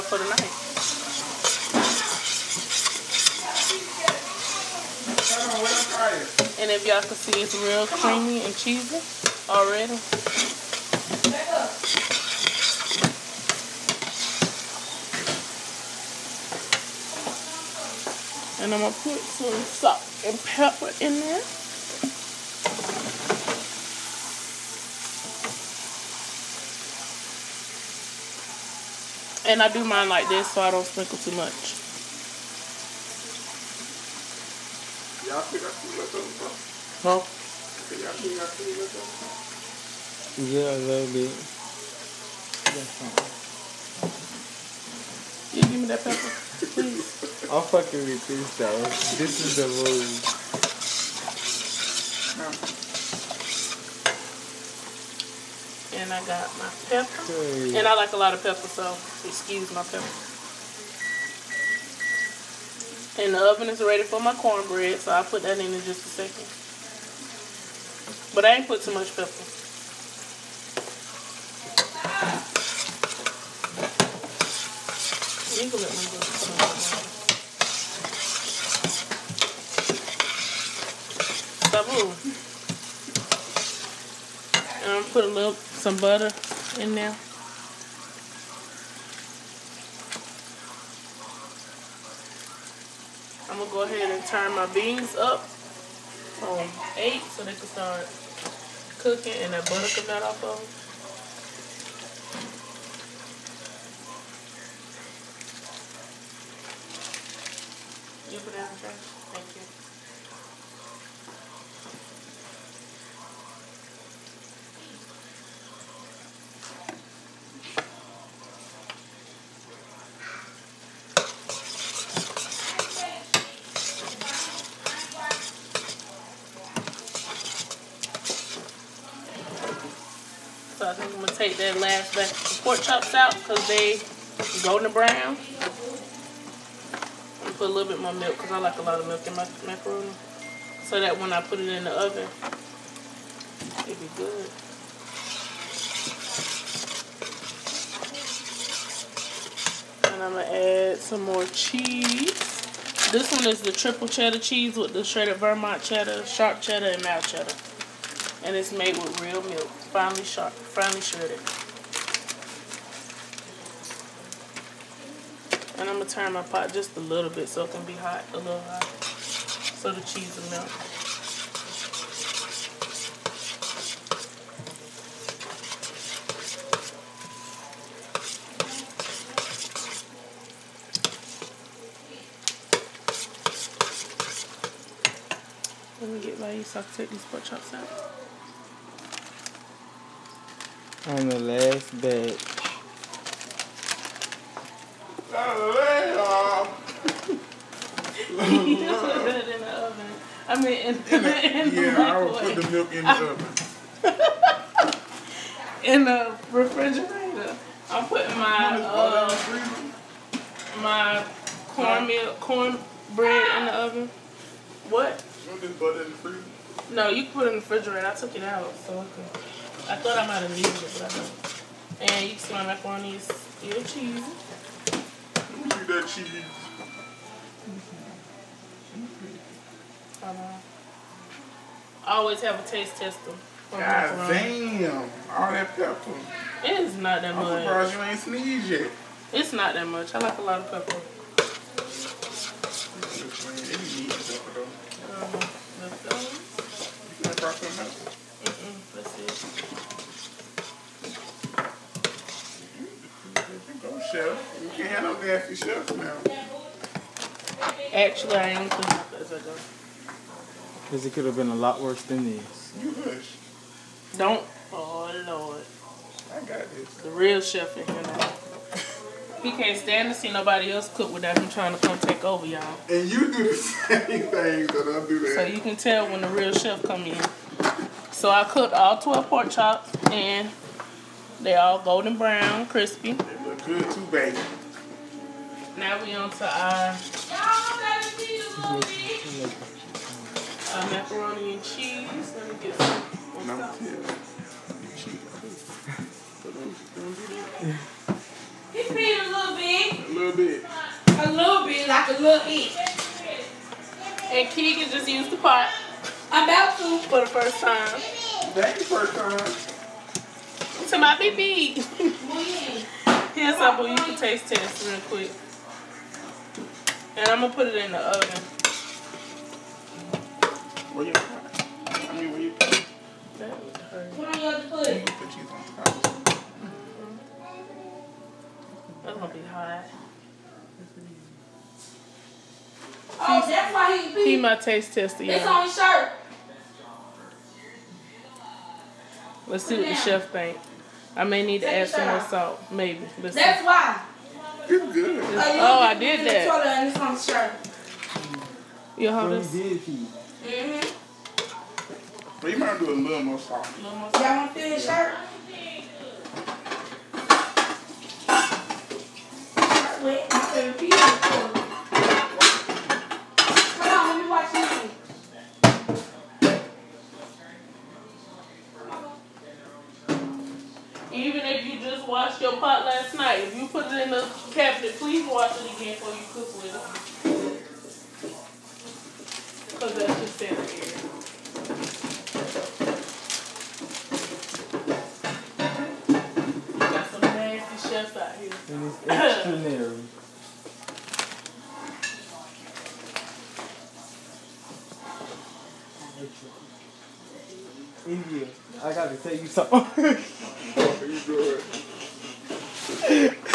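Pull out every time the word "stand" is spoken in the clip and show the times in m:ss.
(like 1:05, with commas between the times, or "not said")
4:29.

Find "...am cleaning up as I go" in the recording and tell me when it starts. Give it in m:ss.
4:18.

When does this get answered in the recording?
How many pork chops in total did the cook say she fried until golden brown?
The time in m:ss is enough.
4:38.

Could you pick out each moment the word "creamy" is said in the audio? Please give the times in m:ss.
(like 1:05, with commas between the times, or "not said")
0:07.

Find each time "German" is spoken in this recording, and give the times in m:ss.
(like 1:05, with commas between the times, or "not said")
not said.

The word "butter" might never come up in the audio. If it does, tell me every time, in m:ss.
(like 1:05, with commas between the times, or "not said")
1:25, 1:39.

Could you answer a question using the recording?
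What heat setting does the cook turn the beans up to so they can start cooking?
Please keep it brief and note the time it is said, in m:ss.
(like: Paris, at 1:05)
8, at 1:36.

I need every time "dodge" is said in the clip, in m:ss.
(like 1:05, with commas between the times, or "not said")
not said.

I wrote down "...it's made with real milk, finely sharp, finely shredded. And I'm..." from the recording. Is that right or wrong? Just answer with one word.
right.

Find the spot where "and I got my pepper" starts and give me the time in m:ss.
0:56.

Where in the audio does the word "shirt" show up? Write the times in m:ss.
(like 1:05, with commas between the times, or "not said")
5:35, 5:47, 5:54.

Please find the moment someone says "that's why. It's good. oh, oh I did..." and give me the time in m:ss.
5:43.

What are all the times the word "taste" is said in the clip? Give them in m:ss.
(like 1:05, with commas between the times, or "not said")
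3:52, 5:14, 5:34.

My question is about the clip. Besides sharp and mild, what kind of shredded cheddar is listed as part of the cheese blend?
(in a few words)
Vermont cheddar.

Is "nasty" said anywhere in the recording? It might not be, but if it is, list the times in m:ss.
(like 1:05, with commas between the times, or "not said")
4:15.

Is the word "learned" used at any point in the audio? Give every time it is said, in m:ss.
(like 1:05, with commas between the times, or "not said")
not said.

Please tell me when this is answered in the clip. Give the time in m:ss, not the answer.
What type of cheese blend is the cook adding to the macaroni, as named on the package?
2:33.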